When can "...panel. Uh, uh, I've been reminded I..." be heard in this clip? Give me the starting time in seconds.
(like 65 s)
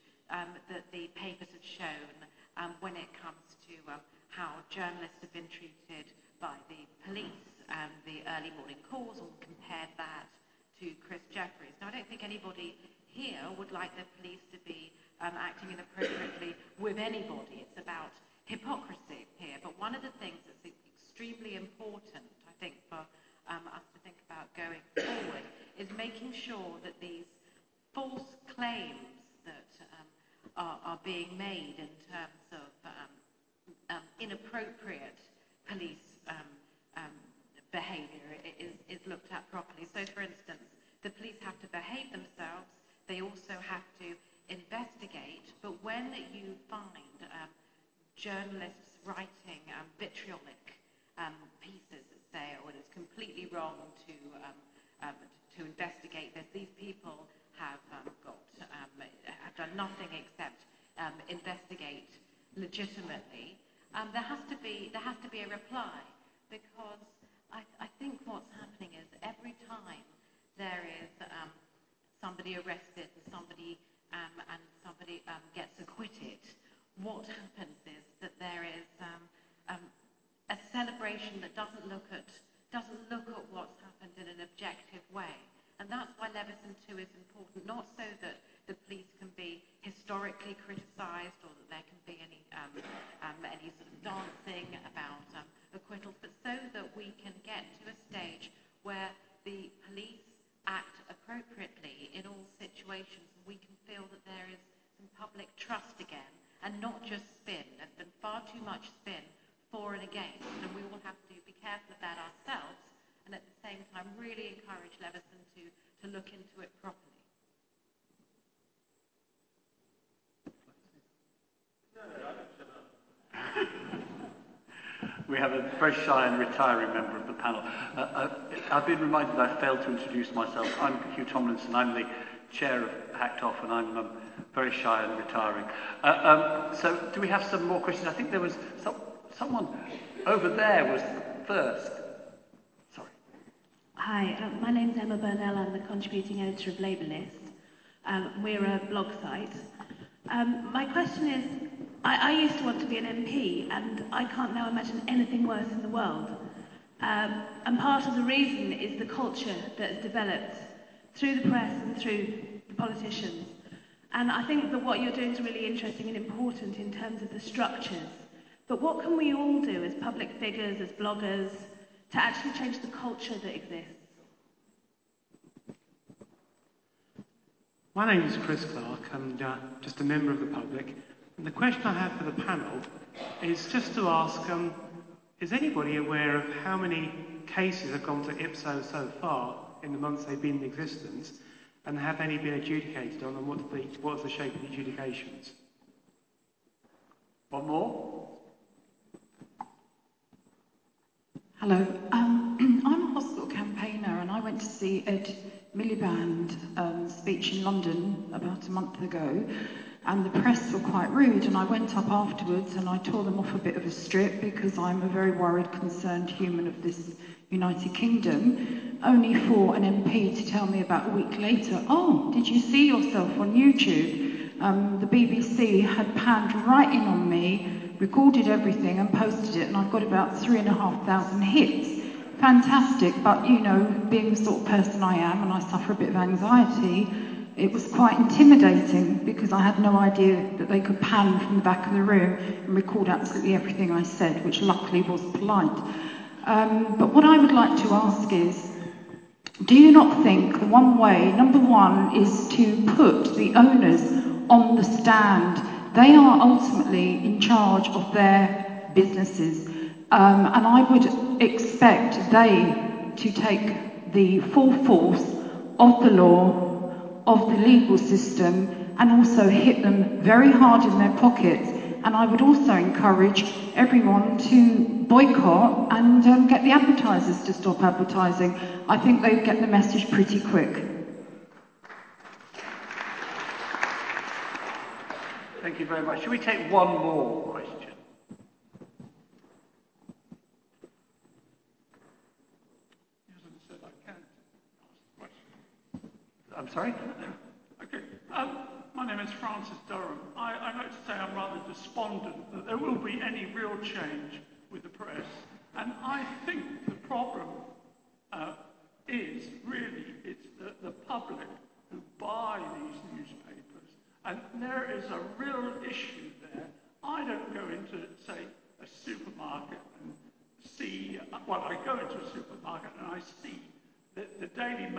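127 s.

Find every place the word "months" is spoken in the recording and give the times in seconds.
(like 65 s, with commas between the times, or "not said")
189 s, 208 s.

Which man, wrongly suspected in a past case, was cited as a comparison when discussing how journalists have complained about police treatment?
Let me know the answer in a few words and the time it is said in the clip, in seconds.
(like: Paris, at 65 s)
Chris Jefferies, at 11 s.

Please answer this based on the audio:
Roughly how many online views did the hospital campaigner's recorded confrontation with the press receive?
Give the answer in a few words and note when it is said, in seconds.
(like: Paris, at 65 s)
3,500, at 230 s.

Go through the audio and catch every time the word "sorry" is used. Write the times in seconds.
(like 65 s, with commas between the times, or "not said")
142 s, 296 s.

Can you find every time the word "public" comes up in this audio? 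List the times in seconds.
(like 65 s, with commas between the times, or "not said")
169 s, 180 s, 310 s.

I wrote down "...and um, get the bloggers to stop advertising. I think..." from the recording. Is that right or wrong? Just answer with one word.
wrong.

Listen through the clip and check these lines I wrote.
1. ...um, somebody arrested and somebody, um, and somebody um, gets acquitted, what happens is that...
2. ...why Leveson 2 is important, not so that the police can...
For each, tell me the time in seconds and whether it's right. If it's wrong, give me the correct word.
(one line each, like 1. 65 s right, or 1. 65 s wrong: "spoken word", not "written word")
1. 71 s right
2. 86 s right.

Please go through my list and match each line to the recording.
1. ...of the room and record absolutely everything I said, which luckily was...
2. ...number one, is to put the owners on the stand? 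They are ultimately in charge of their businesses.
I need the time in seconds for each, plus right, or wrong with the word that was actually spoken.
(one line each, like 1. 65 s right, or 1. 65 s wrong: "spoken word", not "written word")
1. 241 s right
2. 251 s right.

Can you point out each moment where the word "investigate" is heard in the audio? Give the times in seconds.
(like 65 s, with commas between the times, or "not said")
44 s, 55 s, 61 s.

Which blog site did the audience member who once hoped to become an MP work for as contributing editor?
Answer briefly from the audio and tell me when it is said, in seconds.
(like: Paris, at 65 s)
Labour List, at 146 s.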